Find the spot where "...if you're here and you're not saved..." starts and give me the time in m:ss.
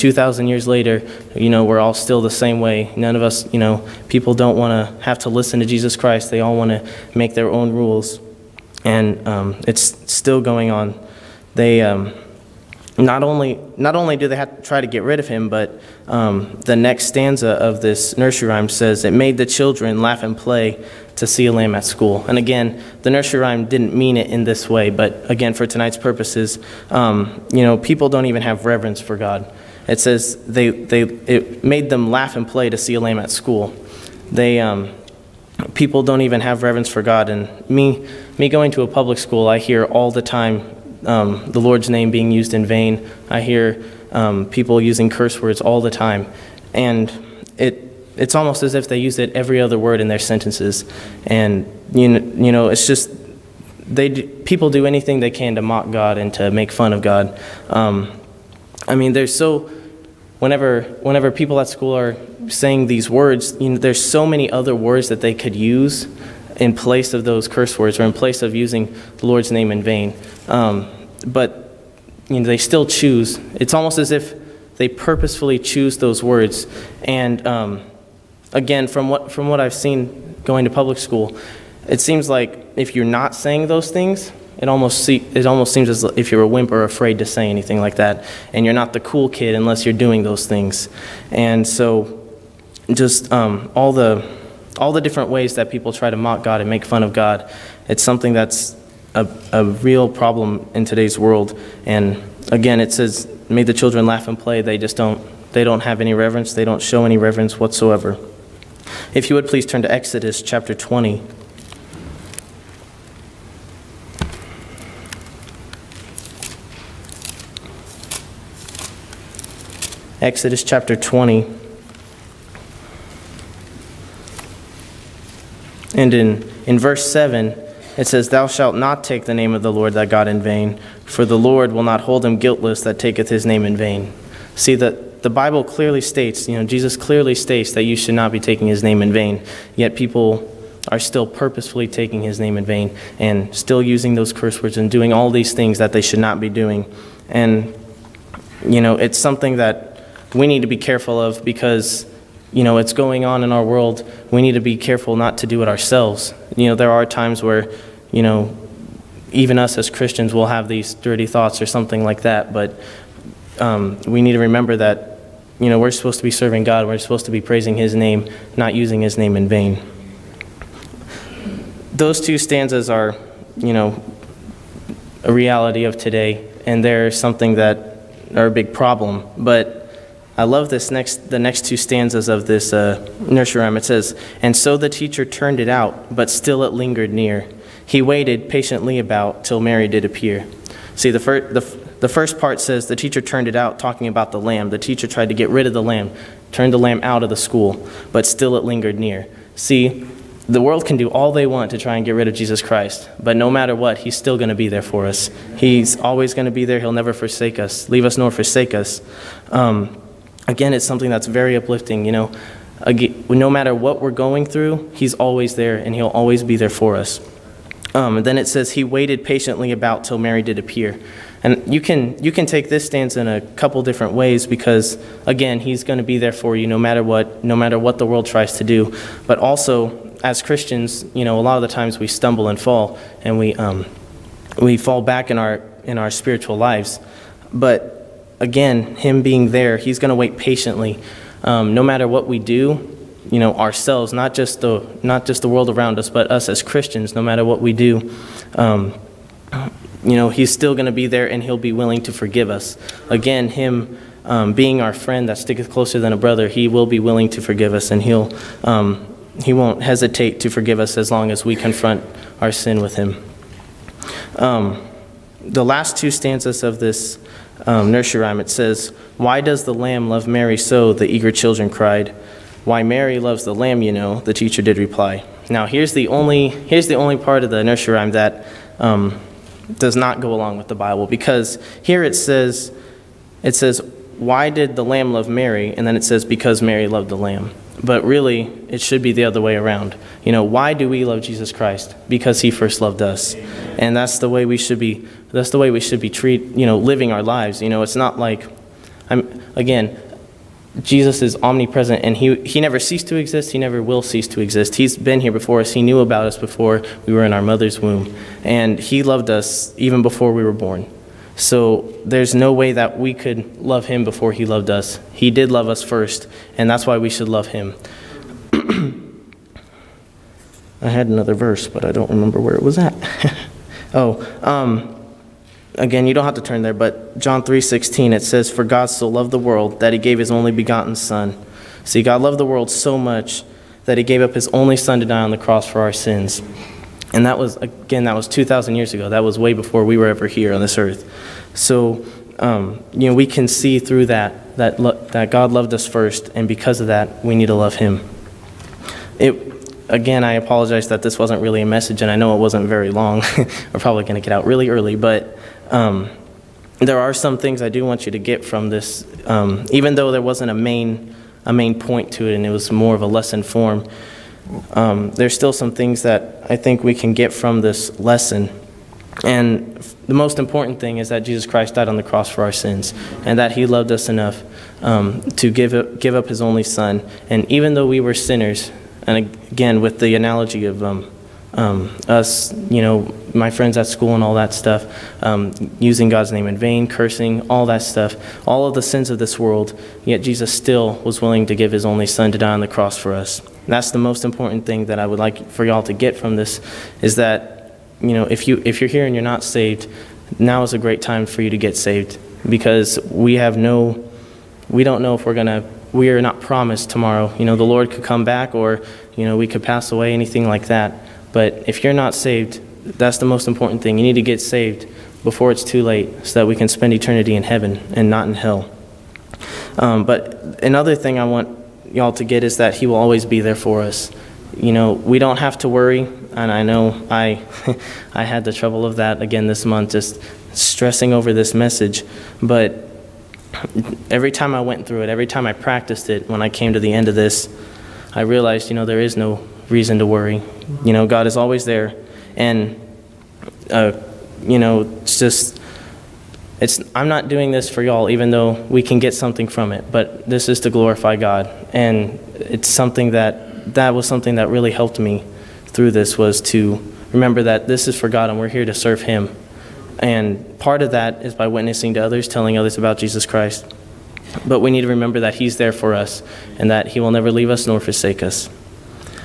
6:38.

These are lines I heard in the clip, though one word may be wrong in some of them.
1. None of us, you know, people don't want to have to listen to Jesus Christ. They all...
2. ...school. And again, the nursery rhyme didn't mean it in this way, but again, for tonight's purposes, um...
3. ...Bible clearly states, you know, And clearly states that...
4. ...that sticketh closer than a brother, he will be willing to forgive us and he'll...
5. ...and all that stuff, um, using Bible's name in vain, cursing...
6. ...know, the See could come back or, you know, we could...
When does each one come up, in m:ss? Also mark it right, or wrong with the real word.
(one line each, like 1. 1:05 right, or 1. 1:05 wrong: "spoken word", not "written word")
1. 0:02 right
2. 0:21 right
3. 2:15 wrong: "Jesus", not "And"
4. 4:15 right
5. 6:24 wrong: "God", not "Bible"
6. 6:47 wrong: "Lord", not "See".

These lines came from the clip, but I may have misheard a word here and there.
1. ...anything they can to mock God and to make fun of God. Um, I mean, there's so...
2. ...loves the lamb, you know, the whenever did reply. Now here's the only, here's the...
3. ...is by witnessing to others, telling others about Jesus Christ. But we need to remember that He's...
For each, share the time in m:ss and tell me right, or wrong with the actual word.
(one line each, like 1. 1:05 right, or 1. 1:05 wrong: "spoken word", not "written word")
1. 0:54 right
2. 4:33 wrong: "teacher", not "whenever"
3. 7:41 right.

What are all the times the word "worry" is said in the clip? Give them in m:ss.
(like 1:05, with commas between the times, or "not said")
7:05, 7:20.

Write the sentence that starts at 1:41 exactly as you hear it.
And again, it says, make the children laugh and play.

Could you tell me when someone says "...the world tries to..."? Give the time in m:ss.
3:47.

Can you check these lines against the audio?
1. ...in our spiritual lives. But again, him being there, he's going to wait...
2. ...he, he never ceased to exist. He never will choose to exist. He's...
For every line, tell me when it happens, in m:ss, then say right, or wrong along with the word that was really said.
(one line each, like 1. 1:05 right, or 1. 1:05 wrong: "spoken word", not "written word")
1. 3:55 right
2. 5:02 wrong: "cease", not "choose".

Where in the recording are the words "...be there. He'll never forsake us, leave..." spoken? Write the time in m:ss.
3:26.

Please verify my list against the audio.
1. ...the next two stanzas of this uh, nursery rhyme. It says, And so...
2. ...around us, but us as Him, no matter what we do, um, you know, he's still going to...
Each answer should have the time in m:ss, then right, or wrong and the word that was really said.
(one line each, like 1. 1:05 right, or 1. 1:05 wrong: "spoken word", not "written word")
1. 3:01 right
2. 4:05 wrong: "Christians", not "Him".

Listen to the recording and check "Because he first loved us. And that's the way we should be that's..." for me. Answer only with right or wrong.
right.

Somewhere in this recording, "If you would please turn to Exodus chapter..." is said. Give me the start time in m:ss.
1:49.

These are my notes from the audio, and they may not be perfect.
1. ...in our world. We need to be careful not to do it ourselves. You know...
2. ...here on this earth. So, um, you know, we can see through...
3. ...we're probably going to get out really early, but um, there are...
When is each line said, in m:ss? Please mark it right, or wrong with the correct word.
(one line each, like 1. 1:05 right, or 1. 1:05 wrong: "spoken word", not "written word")
1. 2:33 right
2. 5:40 right
3. 5:53 right.